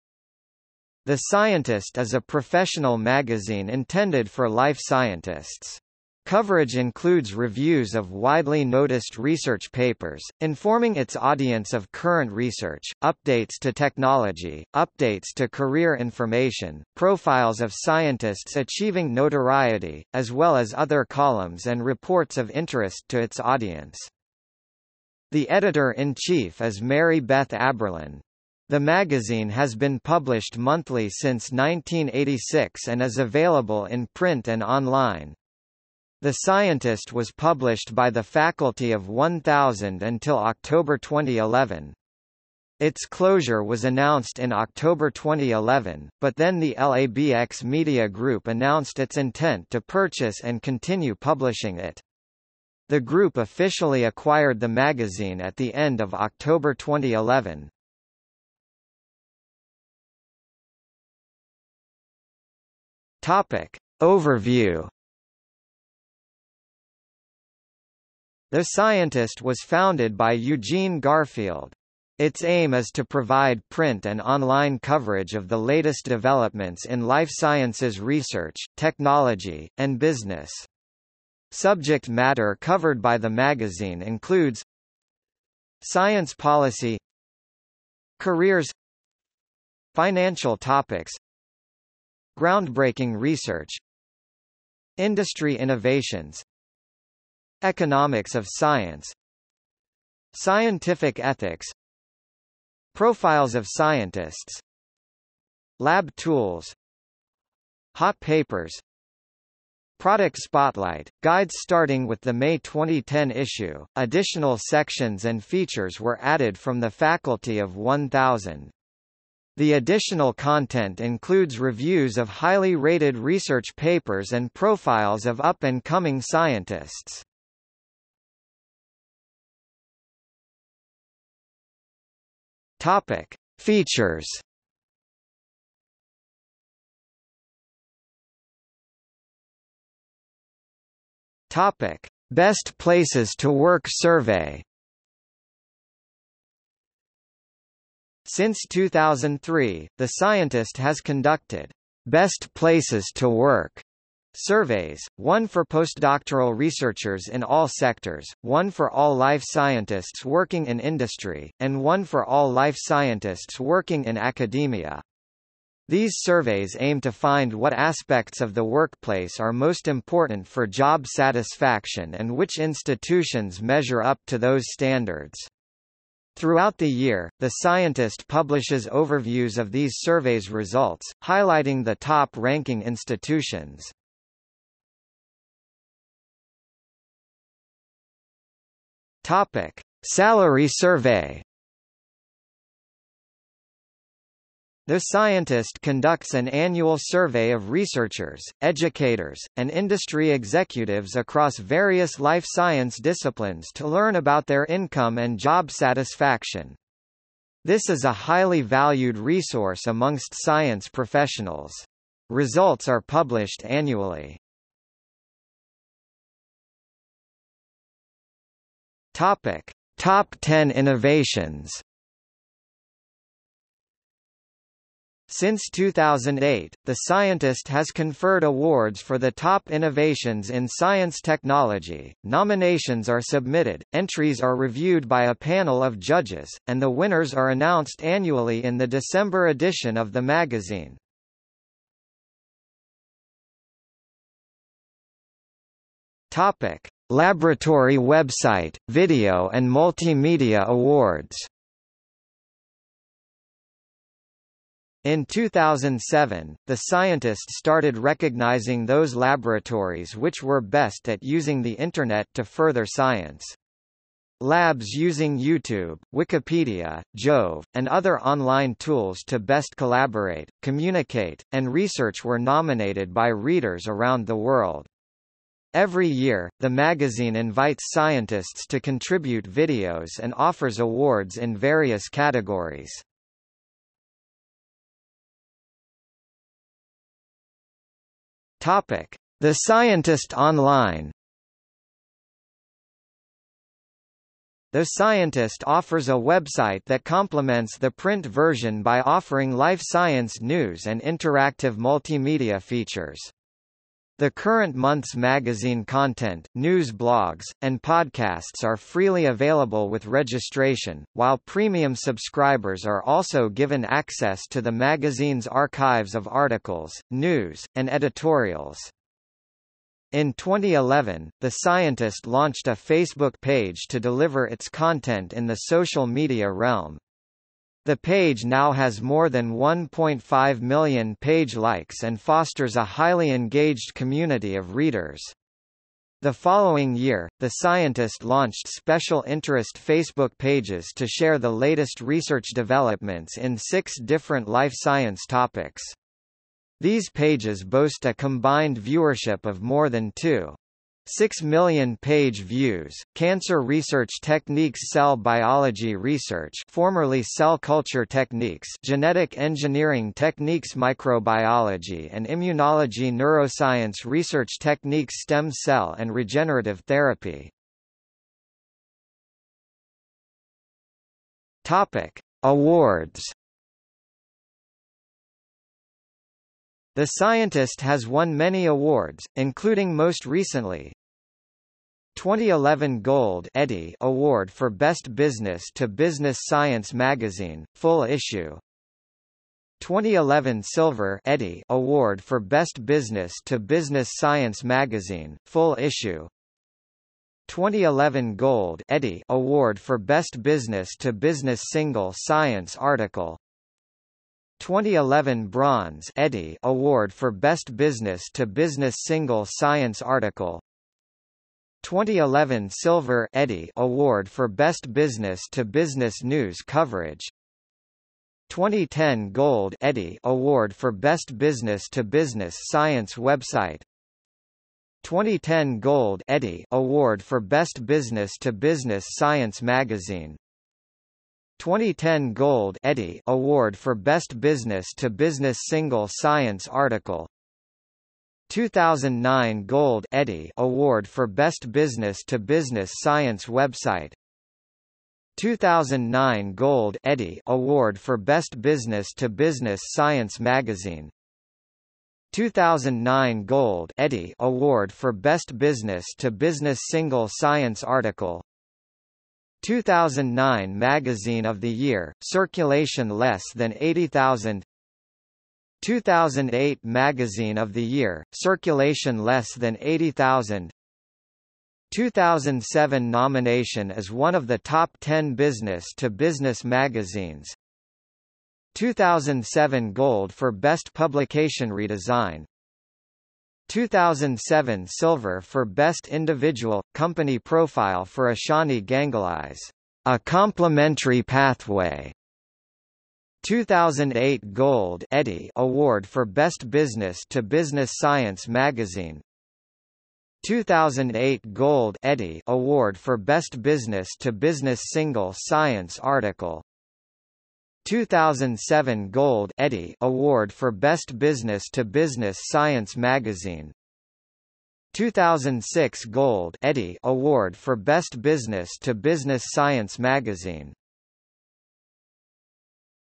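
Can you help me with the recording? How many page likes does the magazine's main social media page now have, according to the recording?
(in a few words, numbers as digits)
1.5 million.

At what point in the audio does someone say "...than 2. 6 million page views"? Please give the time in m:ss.
5:49.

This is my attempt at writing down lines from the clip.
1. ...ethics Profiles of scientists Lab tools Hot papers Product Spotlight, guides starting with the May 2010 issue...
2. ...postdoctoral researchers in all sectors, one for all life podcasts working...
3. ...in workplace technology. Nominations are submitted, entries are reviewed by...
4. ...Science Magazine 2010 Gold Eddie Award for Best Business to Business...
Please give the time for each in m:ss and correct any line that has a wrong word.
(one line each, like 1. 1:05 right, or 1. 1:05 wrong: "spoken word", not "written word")
1. 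1:41 right
2. 2:35 wrong: "scientists", not "podcasts"
3. 3:50 wrong: "science", not "workplace"
4. 7:09 right.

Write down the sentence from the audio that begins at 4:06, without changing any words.
Topic: Laboratory website, video and multimedia awards.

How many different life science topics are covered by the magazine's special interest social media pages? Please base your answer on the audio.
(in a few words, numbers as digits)
6.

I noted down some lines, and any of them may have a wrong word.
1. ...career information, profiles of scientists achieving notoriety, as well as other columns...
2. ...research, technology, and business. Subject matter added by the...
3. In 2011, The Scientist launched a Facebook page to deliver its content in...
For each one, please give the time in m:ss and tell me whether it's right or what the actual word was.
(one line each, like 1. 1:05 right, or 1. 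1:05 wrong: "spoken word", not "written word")
1. 0:15 right
2. 1:17 wrong: "covered", not "added"
3. 5:20 right.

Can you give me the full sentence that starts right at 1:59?
The additional content includes reviews of highly rated research papers and profiles of up-and-coming scientists.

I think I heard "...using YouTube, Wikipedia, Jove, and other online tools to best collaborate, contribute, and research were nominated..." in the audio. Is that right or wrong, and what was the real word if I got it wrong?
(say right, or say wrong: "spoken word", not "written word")
wrong: "communicate", not "contribute".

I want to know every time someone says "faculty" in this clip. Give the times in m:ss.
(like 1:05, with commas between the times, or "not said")
0:38, 1:56.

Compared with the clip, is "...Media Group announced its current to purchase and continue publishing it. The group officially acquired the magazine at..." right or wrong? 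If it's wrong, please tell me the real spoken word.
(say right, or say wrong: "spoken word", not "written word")
wrong: "intent", not "current".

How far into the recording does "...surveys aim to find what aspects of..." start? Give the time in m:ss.
2:46.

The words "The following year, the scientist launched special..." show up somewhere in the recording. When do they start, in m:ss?
5:36.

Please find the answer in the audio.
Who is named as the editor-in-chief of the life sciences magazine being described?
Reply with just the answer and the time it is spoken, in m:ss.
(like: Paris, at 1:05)
Mary Beth Aberlin, at 0:26.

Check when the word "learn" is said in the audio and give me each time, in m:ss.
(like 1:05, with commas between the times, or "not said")
3:23.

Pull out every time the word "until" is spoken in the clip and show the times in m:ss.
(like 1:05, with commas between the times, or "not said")
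0:40.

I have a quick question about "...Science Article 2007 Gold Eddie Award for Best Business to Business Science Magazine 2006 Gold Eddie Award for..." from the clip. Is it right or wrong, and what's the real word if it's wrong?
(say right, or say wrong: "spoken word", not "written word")
right.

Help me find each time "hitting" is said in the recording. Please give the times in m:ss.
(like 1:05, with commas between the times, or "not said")
not said.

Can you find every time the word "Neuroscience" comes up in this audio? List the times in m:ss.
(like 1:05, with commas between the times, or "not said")
6:03.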